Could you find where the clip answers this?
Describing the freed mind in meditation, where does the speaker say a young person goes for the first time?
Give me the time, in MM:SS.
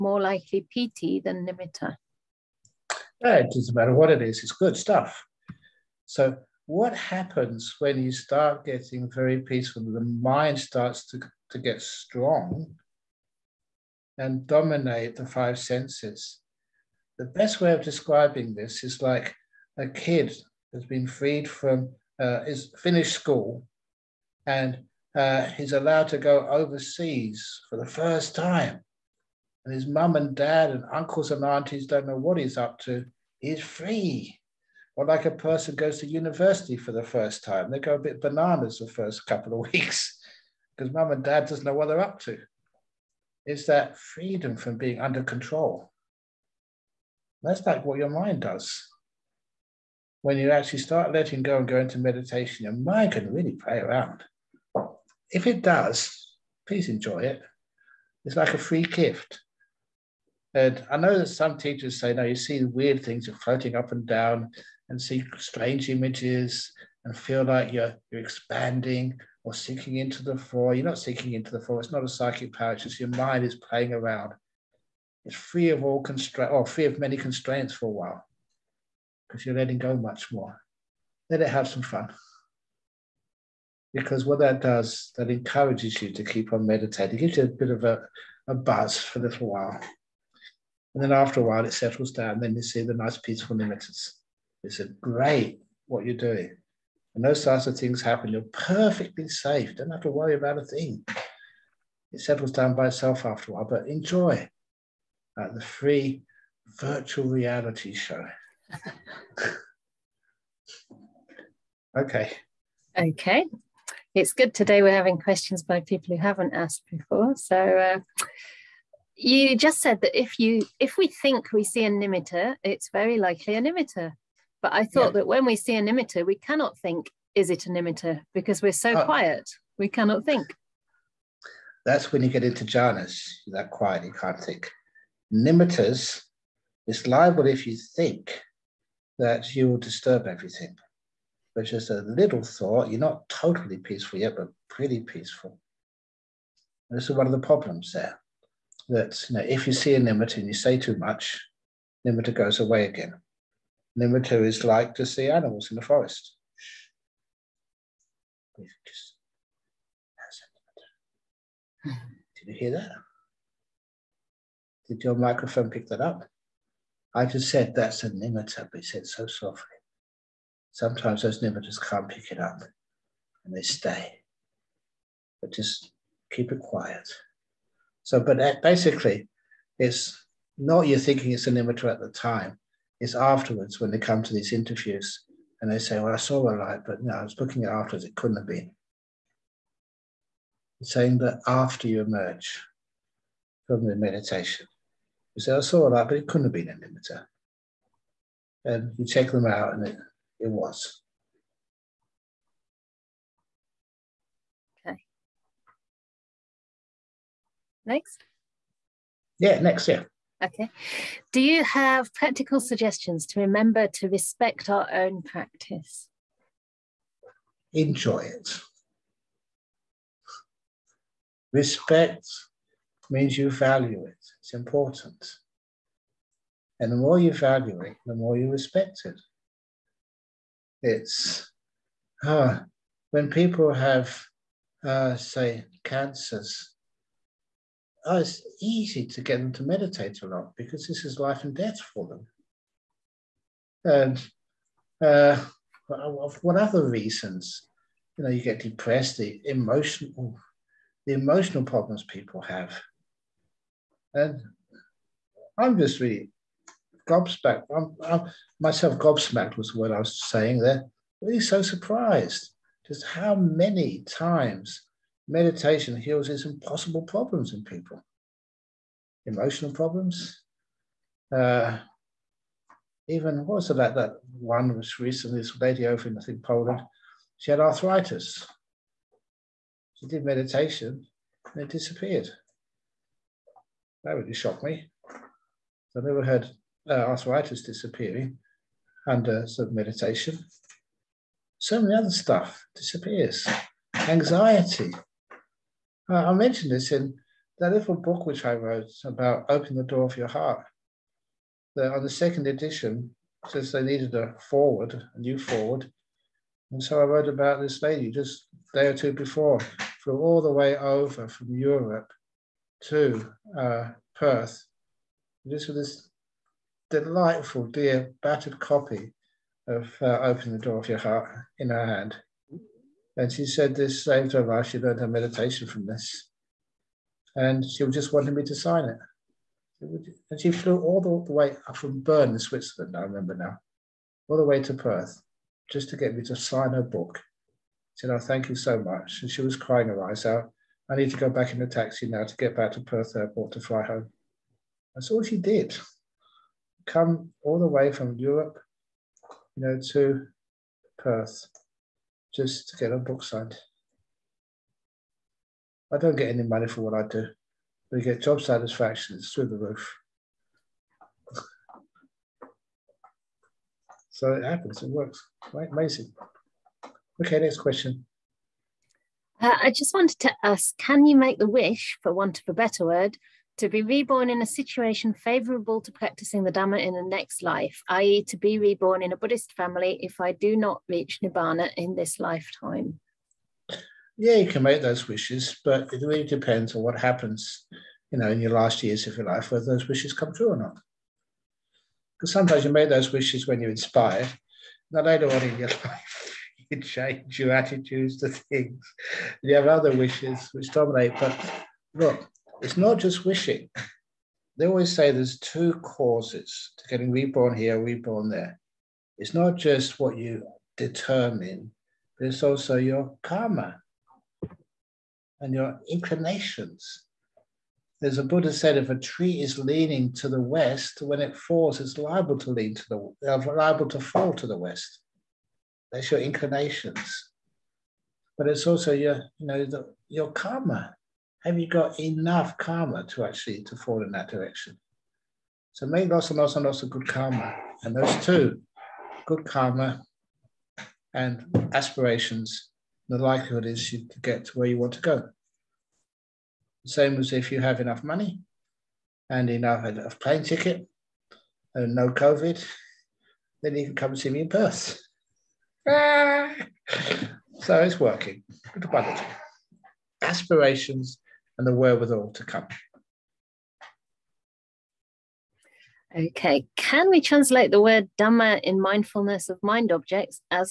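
00:36.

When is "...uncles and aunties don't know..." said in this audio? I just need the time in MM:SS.
00:30.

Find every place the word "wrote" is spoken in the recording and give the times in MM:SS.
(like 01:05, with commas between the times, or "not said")
04:58, 05:07.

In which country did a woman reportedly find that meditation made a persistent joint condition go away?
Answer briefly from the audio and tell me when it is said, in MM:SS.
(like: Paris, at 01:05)
Poland, at 04:36.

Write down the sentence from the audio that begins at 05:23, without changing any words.
And she said this same to her she learned her meditation from this.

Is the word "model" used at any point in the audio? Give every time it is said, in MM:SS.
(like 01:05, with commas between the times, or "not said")
not said.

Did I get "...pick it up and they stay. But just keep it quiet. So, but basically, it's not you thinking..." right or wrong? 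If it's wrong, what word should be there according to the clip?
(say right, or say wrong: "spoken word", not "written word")
right.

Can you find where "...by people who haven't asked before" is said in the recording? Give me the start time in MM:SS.
01:55.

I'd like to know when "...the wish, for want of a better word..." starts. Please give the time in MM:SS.
06:11.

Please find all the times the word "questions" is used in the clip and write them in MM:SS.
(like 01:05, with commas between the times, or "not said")
01:55, 06:07.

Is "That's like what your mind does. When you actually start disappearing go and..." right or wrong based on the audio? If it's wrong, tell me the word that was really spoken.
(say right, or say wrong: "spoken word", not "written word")
wrong: "letting", not "disappearing".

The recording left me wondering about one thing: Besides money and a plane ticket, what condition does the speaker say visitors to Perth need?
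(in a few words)
no COVID.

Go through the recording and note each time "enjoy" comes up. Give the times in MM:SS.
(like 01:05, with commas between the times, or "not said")
00:56, 01:43, 03:37.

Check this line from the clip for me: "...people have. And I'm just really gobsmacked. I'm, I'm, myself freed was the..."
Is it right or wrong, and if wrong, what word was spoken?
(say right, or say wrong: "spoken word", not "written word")
wrong: "gobsmacked", not "freed".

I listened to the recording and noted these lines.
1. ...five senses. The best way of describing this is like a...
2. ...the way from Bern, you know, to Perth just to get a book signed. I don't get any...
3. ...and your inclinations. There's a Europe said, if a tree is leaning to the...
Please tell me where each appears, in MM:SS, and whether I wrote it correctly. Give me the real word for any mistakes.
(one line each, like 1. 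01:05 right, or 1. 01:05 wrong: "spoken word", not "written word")
1. 00:15 right
2. 05:47 wrong: "Europe", not "Bern"
3. 06:55 wrong: "Buddha", not "Europe".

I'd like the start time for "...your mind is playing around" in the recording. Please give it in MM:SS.
01:12.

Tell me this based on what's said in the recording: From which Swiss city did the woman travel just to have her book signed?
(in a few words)
Bern.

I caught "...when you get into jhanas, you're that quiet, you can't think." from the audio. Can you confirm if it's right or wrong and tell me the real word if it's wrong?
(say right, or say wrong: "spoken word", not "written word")
right.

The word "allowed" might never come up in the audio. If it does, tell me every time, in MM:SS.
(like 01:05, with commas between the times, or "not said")
00:25.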